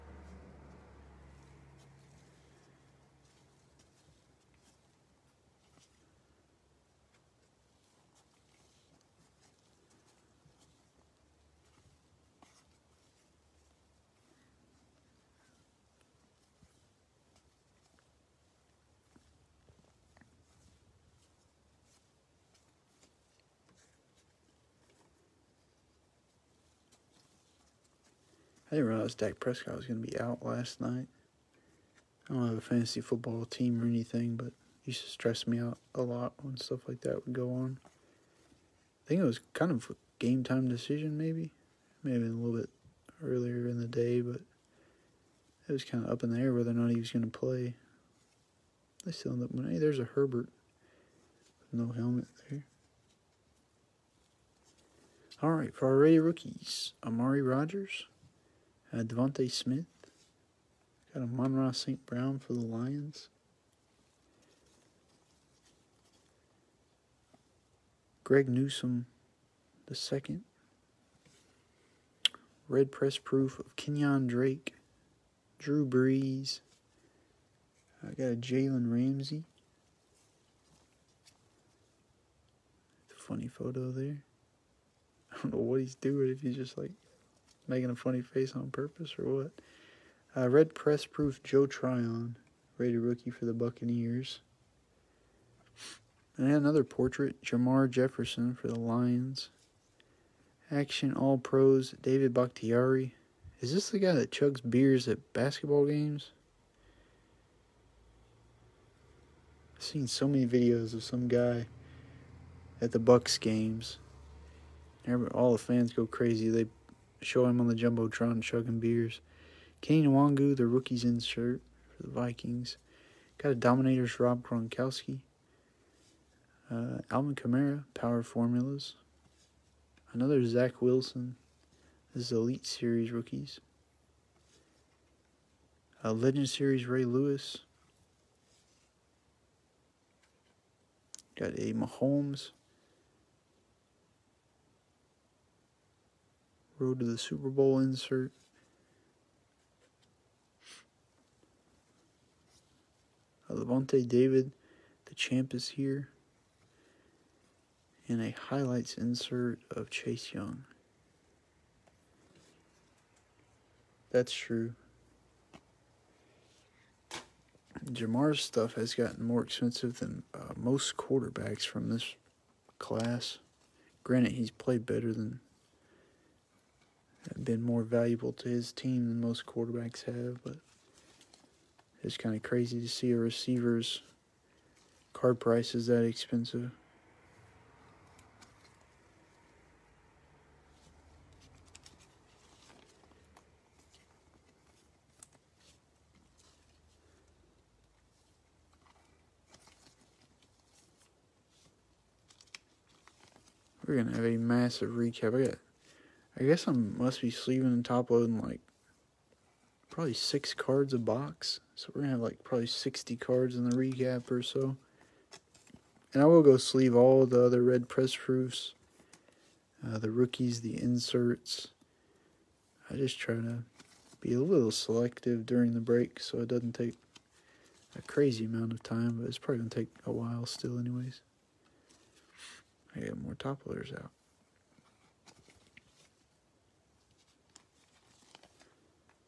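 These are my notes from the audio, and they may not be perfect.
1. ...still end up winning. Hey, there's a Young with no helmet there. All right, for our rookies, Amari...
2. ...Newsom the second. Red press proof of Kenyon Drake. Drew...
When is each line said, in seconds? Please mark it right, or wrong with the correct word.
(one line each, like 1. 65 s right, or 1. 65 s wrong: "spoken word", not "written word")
1. 49 s wrong: "Herbert", not "Young"
2. 68 s right.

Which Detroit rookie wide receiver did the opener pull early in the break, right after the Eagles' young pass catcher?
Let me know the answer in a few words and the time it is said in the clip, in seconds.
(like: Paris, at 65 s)
Amon-Ra St. Brown, at 61 s.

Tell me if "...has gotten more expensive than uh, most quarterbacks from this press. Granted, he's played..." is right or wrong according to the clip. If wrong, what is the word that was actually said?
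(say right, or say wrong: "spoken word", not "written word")
wrong: "class", not "press".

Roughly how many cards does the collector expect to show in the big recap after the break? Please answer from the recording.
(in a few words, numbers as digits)
60.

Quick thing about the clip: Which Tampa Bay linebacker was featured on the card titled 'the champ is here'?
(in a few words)
Lavonte David.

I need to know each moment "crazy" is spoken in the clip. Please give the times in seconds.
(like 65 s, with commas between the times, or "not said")
116 s, 182 s, 228 s.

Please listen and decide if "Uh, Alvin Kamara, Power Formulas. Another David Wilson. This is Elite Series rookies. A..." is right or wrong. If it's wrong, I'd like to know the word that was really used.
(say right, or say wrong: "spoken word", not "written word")
wrong: "Zach", not "David".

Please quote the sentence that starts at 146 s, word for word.
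Road to the Super Bowl insert.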